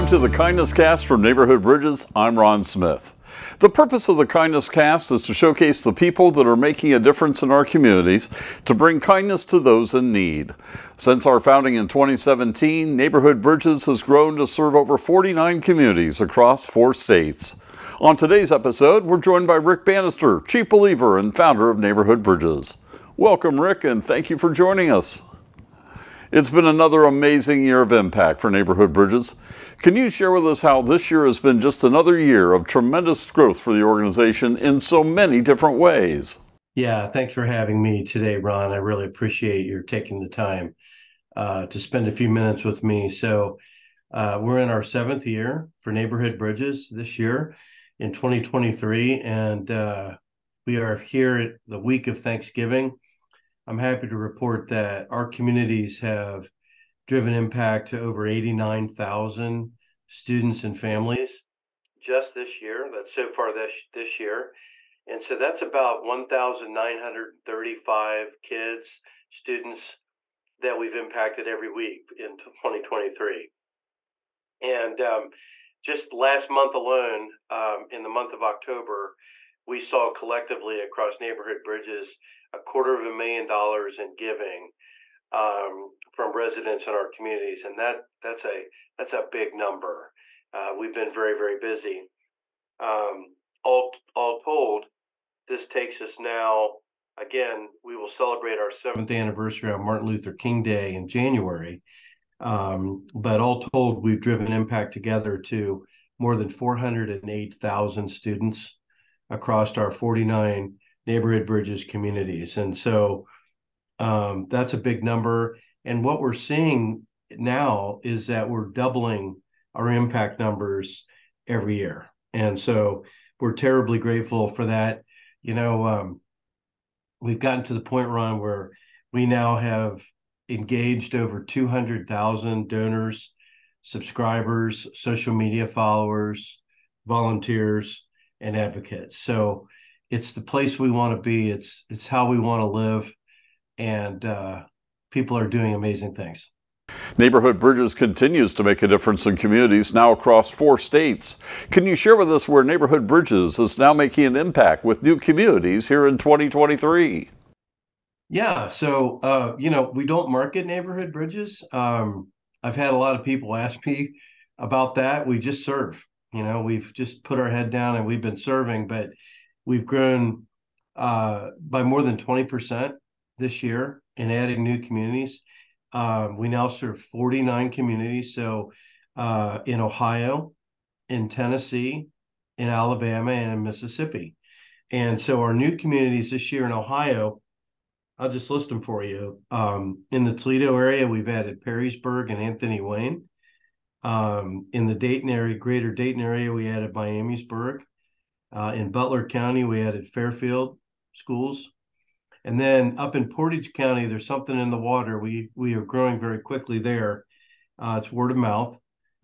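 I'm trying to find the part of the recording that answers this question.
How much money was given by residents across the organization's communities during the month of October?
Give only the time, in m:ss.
1:22.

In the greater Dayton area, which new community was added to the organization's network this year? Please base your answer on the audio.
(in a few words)
Miamisburg.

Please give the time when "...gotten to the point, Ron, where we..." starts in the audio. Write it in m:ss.
2:07.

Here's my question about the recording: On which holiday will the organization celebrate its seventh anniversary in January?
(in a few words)
Martin Luther King Day.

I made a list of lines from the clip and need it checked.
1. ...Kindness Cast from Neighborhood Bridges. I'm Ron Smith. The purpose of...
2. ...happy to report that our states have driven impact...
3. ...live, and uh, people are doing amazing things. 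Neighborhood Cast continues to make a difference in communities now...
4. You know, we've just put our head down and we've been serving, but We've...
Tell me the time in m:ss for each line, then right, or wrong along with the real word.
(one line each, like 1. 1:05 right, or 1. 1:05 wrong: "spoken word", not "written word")
1. 0:00 right
2. 0:53 wrong: "communities", not "states"
3. 2:22 wrong: "Bridges", not "Cast"
4. 2:46 right.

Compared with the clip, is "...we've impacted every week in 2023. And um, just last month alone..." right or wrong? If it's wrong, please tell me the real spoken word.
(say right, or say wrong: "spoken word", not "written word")
right.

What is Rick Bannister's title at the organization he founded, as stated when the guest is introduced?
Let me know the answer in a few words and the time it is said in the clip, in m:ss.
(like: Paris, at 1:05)
Chief Believer, at 0:20.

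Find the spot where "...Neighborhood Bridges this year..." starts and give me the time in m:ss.
0:45.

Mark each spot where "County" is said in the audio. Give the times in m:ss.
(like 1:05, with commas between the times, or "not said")
3:19, 3:23.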